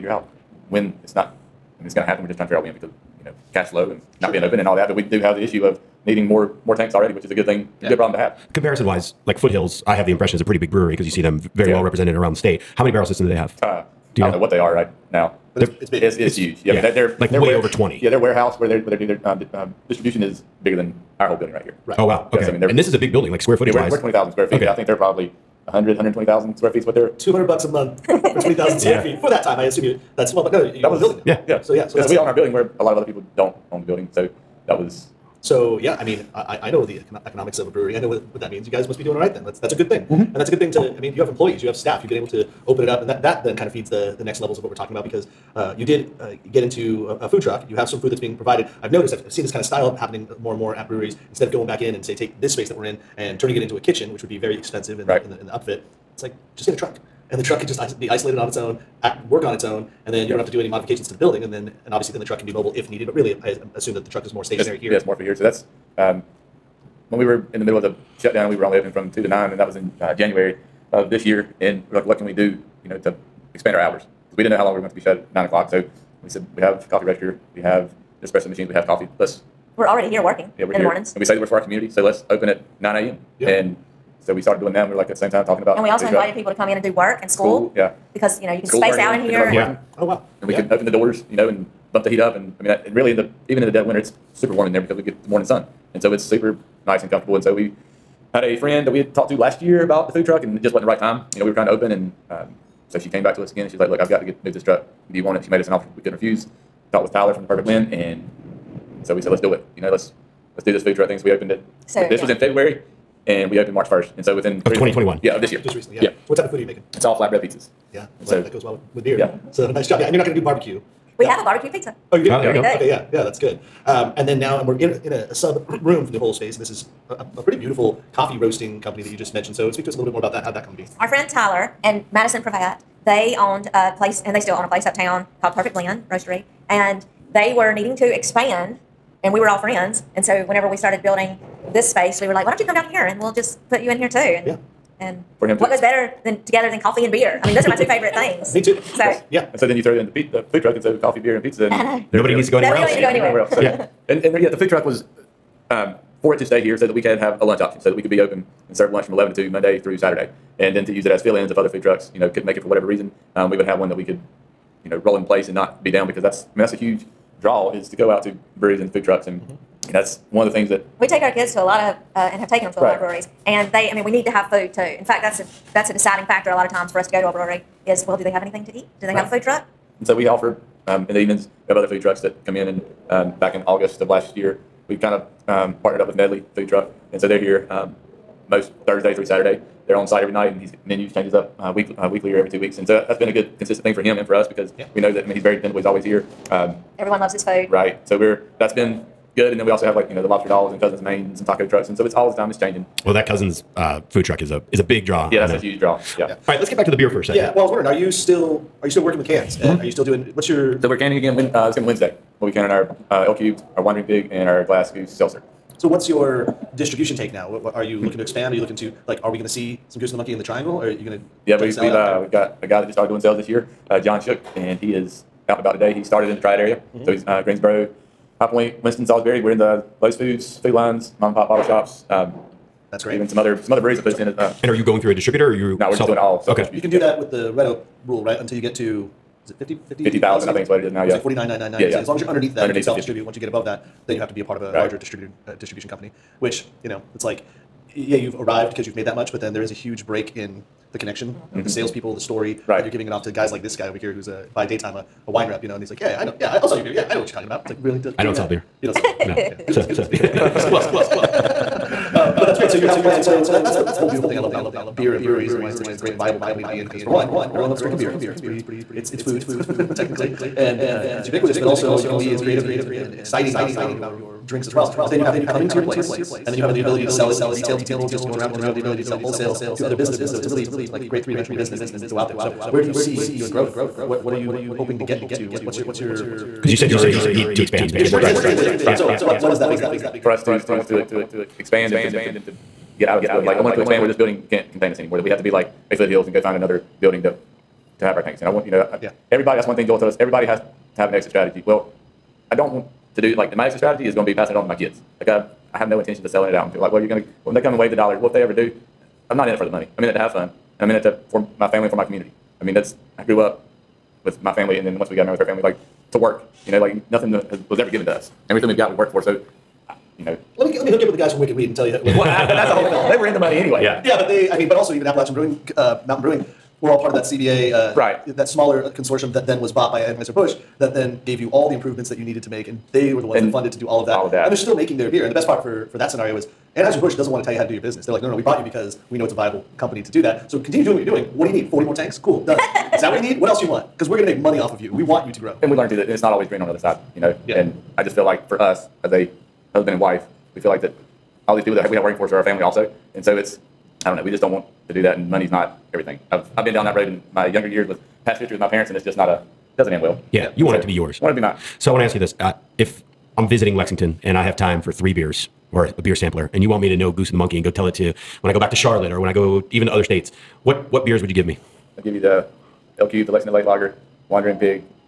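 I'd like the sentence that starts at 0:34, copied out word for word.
So that was so yeah, I mean, I, I know the economics of a brewery.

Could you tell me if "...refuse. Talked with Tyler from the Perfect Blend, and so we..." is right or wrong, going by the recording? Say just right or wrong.
right.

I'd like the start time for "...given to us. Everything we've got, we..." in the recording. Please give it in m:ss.
5:17.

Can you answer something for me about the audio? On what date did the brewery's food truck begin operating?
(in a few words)
March 1.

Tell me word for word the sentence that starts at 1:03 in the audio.
But really, I assume that the truck is more stationary here.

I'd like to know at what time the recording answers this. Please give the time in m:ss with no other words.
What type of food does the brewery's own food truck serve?
1:57.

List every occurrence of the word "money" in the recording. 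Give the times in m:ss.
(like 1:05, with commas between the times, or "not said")
5:09, 5:23, 5:44, 5:55.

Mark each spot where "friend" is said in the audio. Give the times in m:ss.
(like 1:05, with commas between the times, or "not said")
1:38, 2:11, 2:19.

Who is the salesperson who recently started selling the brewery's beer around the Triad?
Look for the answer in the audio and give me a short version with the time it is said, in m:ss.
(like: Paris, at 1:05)
John Shook, at 3:43.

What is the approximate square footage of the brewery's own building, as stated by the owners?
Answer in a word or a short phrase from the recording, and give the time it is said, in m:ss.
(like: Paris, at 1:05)
20,000 square feet, at 0:24.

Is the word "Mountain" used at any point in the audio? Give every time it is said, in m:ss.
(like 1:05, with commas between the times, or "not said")
5:26.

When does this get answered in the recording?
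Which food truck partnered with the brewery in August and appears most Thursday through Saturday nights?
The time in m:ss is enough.
3:06.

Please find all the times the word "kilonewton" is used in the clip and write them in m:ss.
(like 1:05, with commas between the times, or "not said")
not said.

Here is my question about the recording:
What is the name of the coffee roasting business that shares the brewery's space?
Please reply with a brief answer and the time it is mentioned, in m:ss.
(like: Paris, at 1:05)
Perfect Blend Roastery, at 2:15.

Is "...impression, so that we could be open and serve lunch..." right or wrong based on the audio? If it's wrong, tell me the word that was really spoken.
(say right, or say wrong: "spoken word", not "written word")
wrong: "option", not "impression".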